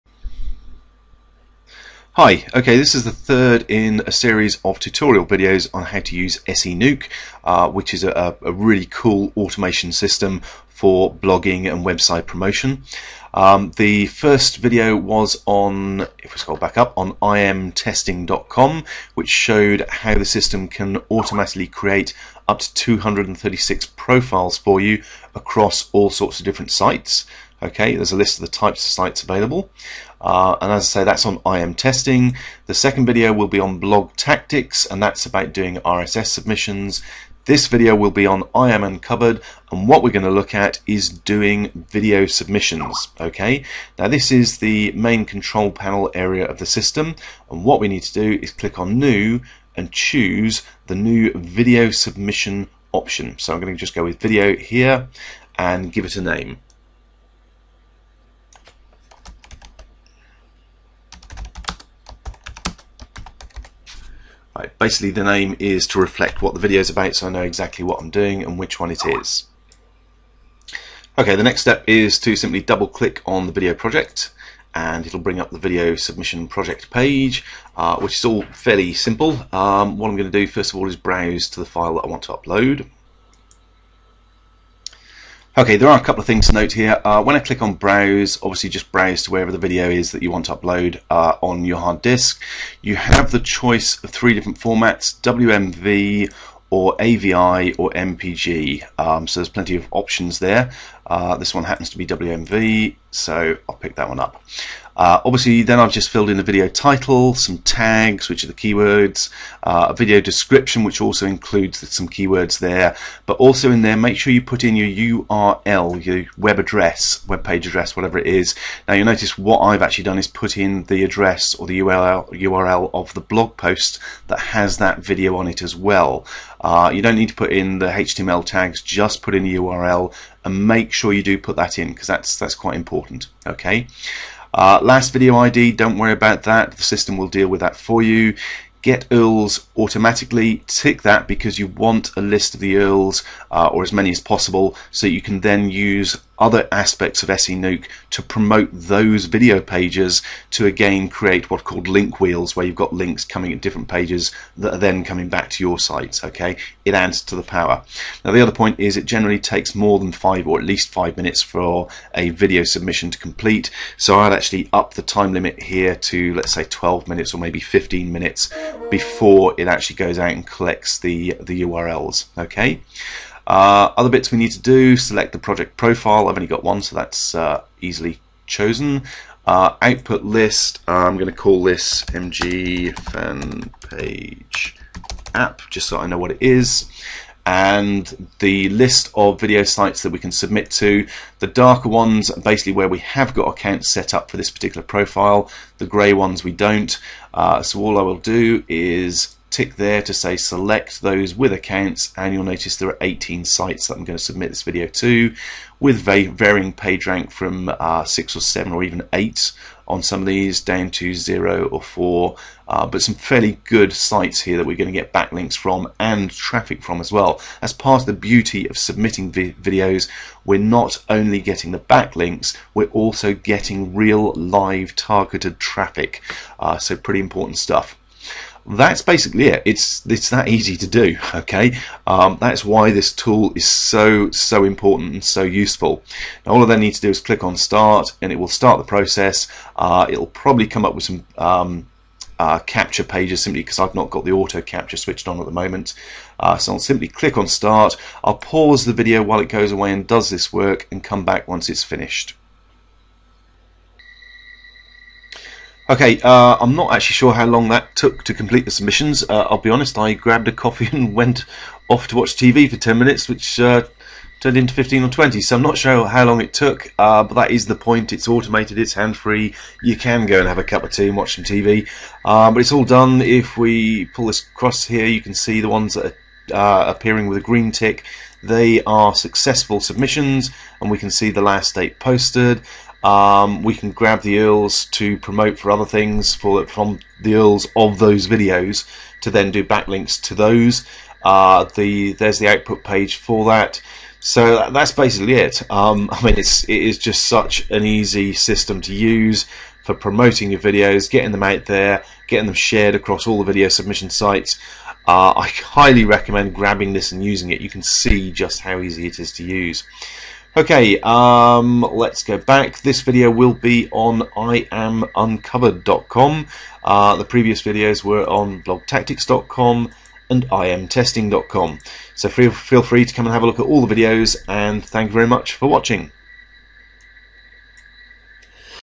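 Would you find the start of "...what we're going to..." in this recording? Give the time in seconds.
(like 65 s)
39 s.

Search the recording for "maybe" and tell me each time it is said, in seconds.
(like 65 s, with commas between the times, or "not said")
167 s.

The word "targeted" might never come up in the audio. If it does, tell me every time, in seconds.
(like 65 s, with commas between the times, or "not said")
224 s.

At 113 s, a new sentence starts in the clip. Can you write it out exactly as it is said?
But also in there, make sure you put in your URL, your web address, web page address, whatever it is.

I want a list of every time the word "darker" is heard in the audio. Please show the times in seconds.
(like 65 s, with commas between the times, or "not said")
191 s.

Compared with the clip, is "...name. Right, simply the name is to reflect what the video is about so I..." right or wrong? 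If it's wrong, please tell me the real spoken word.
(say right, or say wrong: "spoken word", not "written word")
wrong: "basically", not "simply".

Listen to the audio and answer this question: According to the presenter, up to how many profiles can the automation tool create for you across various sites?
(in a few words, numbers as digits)
236.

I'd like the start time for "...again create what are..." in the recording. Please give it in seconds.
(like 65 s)
150 s.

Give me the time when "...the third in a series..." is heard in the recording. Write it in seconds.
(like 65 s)
3 s.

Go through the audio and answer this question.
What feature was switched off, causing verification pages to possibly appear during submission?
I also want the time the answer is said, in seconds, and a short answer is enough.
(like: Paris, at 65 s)
auto capture, at 244 s.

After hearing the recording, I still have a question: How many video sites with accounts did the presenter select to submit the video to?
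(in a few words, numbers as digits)
18.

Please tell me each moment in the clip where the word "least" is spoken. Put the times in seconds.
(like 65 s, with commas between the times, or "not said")
160 s.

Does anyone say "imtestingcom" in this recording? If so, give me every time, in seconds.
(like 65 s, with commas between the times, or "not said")
17 s, 320 s.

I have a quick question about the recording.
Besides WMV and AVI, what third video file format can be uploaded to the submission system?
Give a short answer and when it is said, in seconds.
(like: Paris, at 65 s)
MPG, at 97 s.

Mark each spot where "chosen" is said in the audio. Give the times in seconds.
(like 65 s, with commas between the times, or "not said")
178 s.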